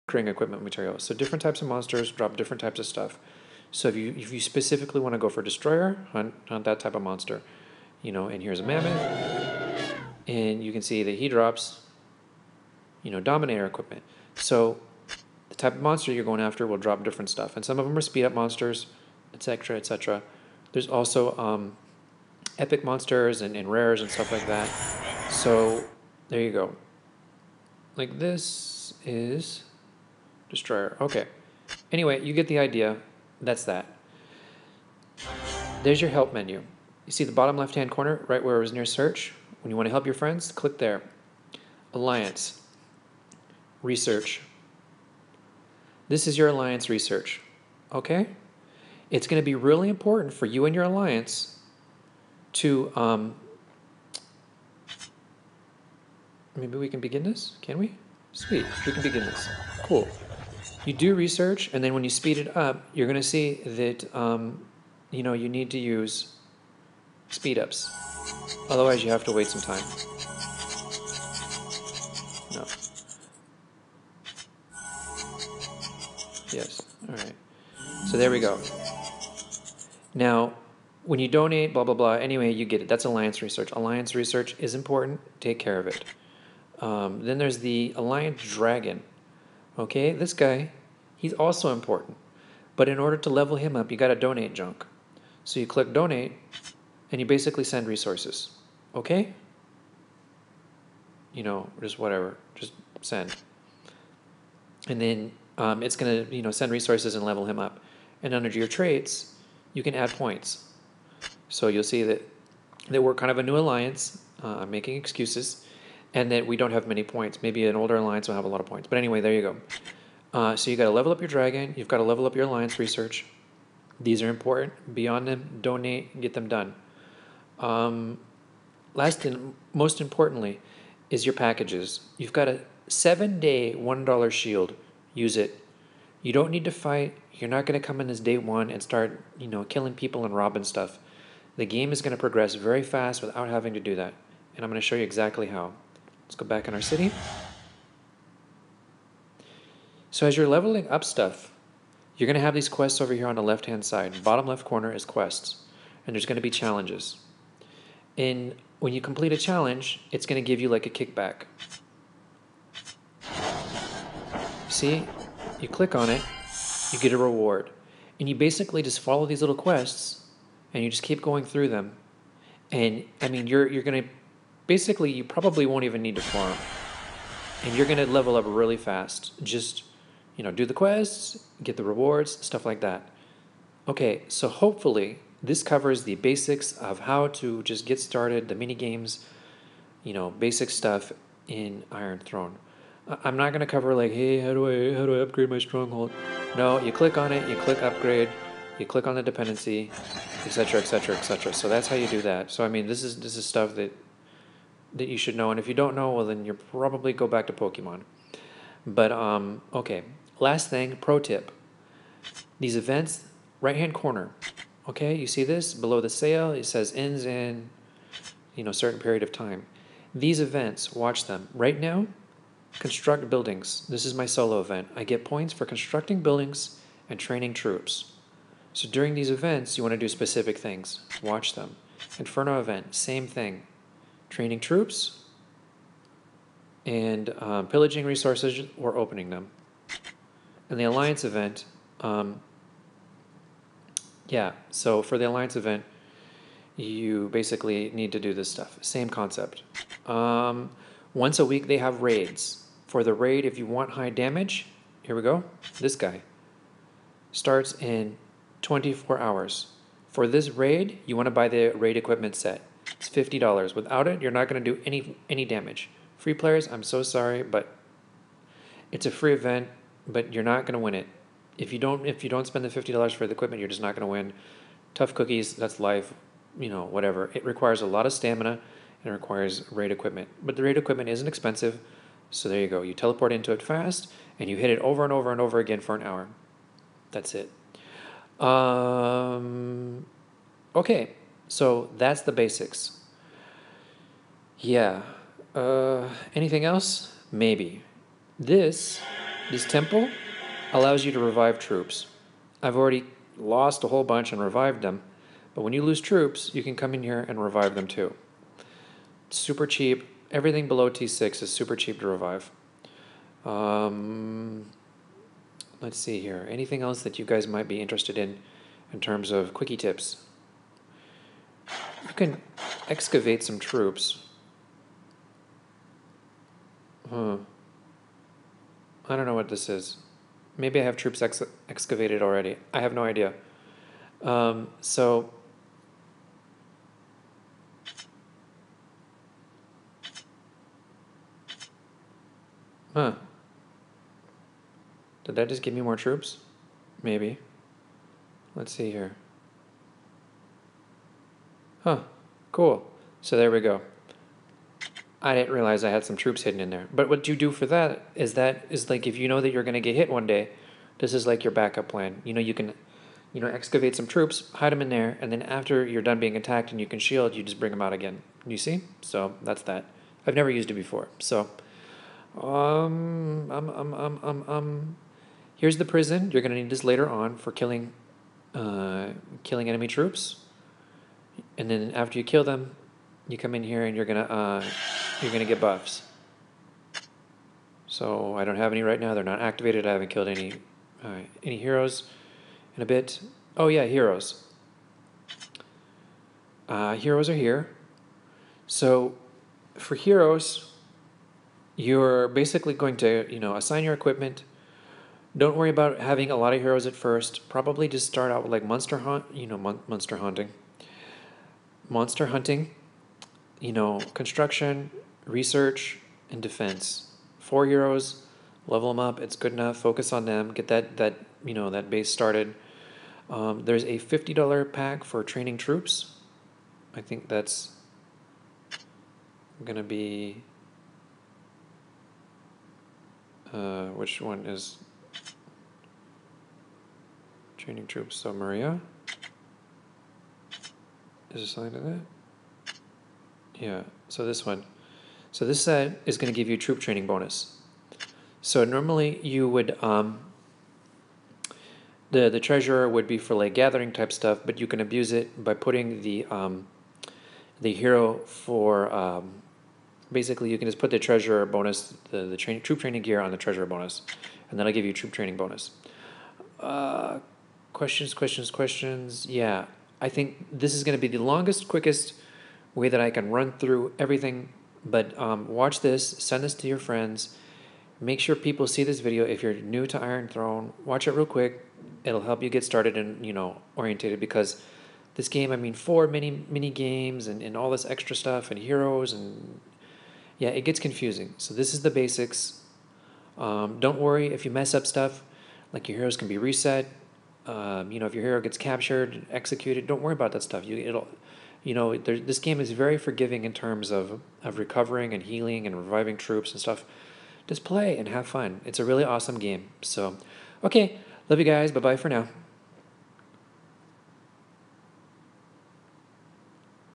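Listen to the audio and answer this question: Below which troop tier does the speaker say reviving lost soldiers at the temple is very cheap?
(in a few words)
T6.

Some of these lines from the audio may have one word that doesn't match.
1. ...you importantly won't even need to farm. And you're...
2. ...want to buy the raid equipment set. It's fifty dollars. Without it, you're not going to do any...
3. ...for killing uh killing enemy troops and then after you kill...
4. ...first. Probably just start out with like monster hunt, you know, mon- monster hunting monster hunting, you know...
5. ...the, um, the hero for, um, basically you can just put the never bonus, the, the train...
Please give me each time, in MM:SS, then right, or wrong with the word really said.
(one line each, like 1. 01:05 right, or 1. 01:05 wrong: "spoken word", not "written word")
1. 02:55 wrong: "probably", not "importantly"
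2. 04:21 right
3. 06:17 right
4. 06:46 right
5. 07:36 wrong: "treasurer", not "never".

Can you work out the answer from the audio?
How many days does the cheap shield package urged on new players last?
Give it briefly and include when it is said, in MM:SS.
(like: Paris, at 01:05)
7, at 02:12.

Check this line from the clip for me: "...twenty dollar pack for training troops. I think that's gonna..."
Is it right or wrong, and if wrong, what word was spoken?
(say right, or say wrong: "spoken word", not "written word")
wrong: "fifty", not "twenty".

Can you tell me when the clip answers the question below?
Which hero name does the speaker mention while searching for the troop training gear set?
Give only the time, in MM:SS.
07:18.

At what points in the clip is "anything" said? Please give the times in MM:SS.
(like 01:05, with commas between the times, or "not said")
04:56, 05:16.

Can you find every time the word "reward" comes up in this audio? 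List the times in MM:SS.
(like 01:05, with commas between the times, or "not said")
02:47, 03:01.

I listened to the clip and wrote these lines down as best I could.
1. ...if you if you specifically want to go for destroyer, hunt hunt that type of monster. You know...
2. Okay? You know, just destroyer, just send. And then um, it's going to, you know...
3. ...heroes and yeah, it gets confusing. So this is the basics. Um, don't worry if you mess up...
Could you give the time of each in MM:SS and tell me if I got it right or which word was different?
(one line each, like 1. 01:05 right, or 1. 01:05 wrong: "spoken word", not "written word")
1. 00:03 right
2. 01:38 wrong: "whatever", not "destroyer"
3. 08:08 right.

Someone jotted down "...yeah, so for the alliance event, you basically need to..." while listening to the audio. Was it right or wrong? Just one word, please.
right.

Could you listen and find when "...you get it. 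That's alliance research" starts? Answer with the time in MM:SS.
01:22.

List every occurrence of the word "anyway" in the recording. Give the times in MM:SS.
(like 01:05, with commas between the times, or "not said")
00:31, 01:22, 01:58.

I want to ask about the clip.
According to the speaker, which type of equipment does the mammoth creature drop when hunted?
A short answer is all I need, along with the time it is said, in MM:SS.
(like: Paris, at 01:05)
Dominator equipment, at 00:13.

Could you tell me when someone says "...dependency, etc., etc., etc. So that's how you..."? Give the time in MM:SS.
03:19.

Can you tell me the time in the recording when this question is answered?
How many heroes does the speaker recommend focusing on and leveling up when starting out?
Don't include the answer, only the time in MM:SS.
06:57.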